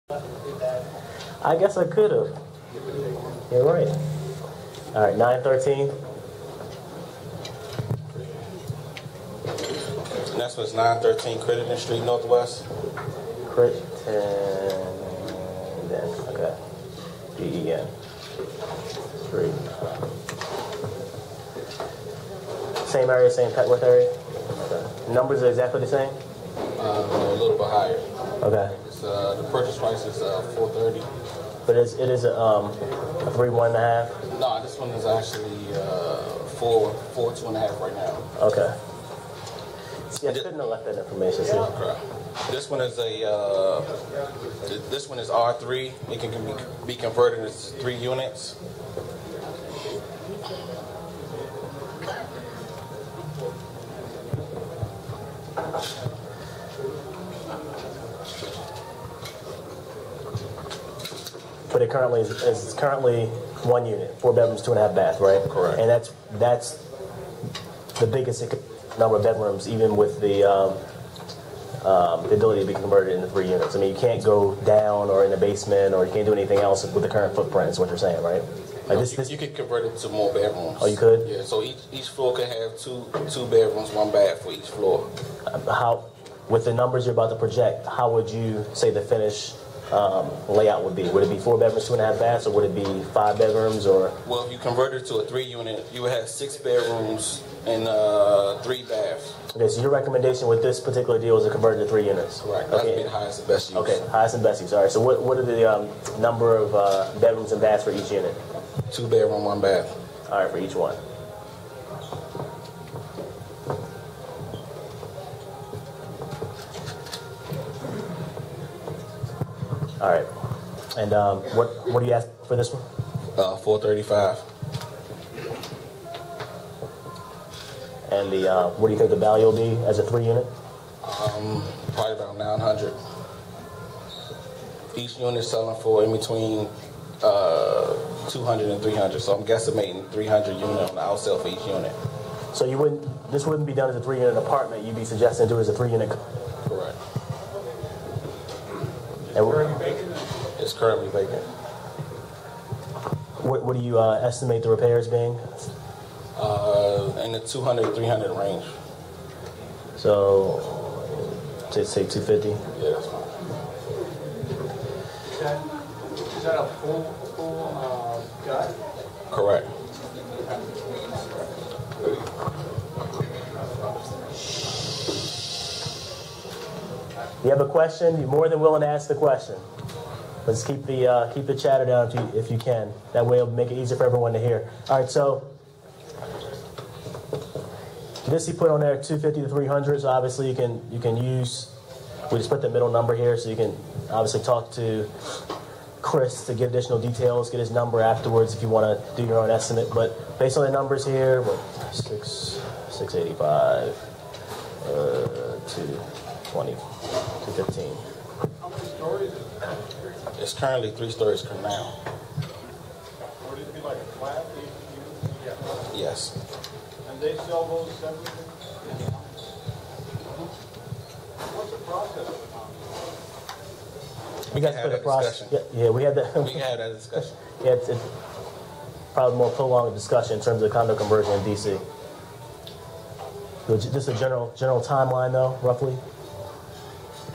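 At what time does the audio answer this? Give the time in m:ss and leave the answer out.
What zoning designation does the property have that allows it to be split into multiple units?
0:45.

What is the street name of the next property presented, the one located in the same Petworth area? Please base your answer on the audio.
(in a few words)
Crittenden Street.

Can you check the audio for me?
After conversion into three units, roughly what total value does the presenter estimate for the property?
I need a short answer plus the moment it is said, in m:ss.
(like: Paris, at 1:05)
$900,000, at 2:12.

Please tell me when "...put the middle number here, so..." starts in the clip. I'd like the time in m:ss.
3:12.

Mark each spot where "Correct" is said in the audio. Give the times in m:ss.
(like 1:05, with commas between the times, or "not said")
1:05, 2:26, 2:49.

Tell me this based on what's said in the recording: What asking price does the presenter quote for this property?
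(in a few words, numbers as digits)
$435,000.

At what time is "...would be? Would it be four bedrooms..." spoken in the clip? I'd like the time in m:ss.
1:30.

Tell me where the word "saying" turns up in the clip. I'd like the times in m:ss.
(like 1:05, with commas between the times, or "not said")
1:17.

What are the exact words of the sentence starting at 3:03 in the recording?
That way, it'll make it easier for everyone to hear.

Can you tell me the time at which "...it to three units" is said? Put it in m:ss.
1:41.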